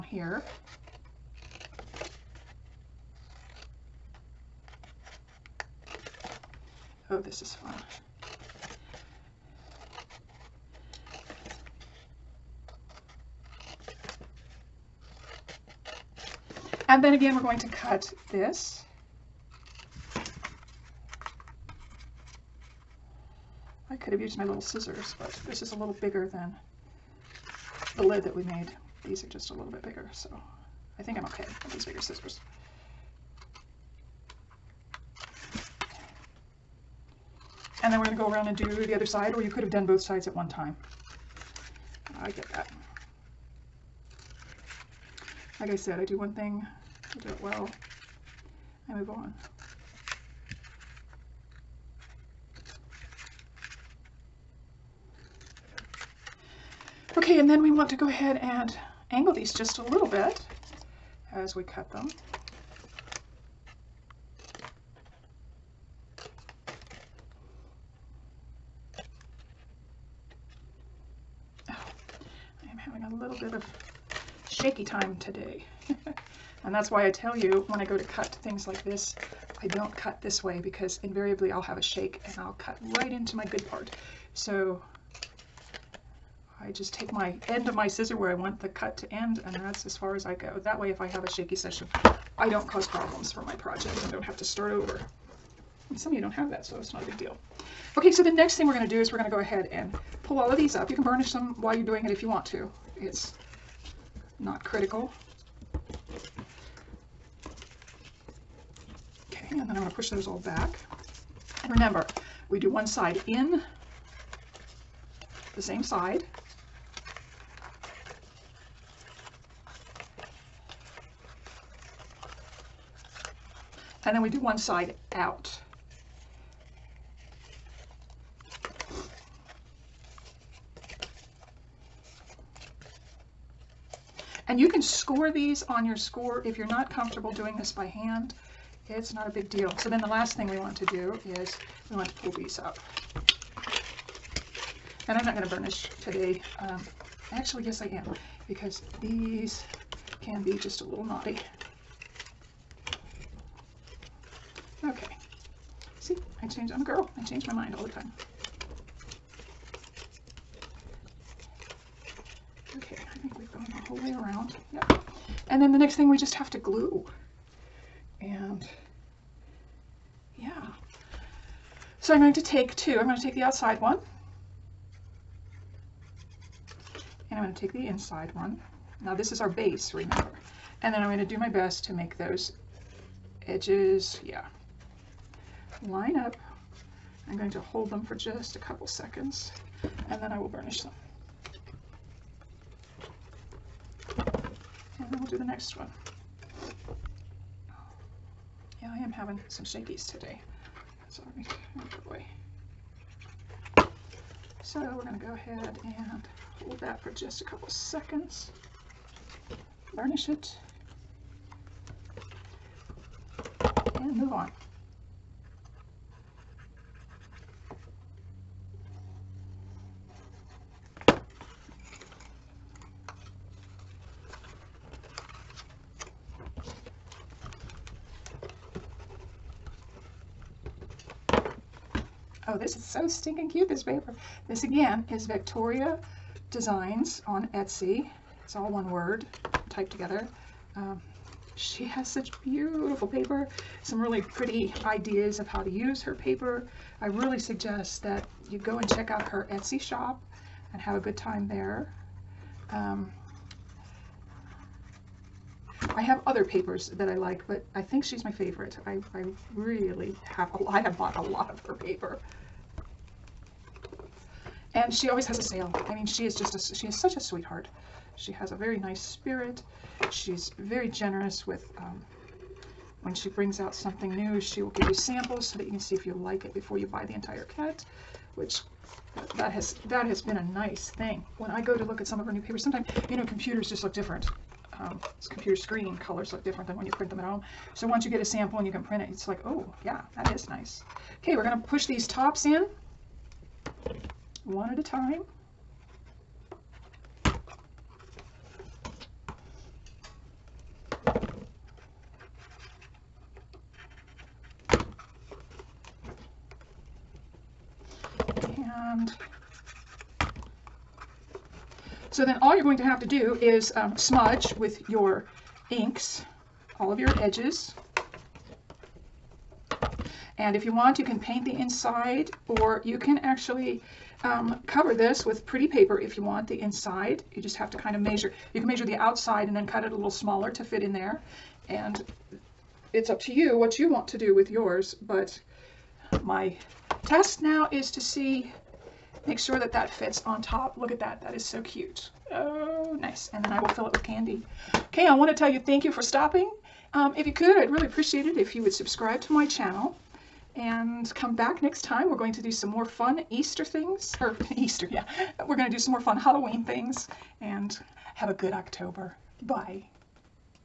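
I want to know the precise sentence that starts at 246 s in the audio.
I really suggest that you go and check out her Etsy shop and have a good time there.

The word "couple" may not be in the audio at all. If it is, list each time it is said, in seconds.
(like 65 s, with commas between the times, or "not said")
188 s, 207 s.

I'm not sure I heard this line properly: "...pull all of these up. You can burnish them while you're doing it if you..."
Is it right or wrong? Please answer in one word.
right.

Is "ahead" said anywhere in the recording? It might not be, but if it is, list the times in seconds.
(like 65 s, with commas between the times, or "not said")
58 s, 99 s, 205 s.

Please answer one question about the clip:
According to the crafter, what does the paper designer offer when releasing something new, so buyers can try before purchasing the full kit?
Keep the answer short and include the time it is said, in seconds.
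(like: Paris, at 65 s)
Samples, at 274 s.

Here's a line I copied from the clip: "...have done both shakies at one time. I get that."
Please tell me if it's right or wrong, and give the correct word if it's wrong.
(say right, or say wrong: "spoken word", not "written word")
wrong: "sides", not "shakies".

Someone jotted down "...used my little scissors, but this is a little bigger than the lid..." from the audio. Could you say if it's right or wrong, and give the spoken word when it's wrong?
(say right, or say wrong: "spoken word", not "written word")
right.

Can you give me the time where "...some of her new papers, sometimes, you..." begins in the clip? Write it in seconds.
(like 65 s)
282 s.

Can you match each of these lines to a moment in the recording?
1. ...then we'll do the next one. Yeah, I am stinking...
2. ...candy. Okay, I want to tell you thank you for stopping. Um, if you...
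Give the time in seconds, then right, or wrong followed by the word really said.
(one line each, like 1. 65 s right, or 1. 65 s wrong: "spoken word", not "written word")
1. 195 s wrong: "having", not "stinking"
2. 344 s right.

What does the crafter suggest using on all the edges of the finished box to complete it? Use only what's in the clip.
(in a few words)
Inks.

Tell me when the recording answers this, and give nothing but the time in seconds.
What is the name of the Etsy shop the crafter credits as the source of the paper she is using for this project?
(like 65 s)
235 s.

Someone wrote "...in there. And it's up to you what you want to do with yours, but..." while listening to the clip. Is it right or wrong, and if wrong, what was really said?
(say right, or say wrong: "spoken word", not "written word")
right.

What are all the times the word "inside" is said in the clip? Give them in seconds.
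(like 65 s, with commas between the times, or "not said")
177 s, 321 s, 326 s.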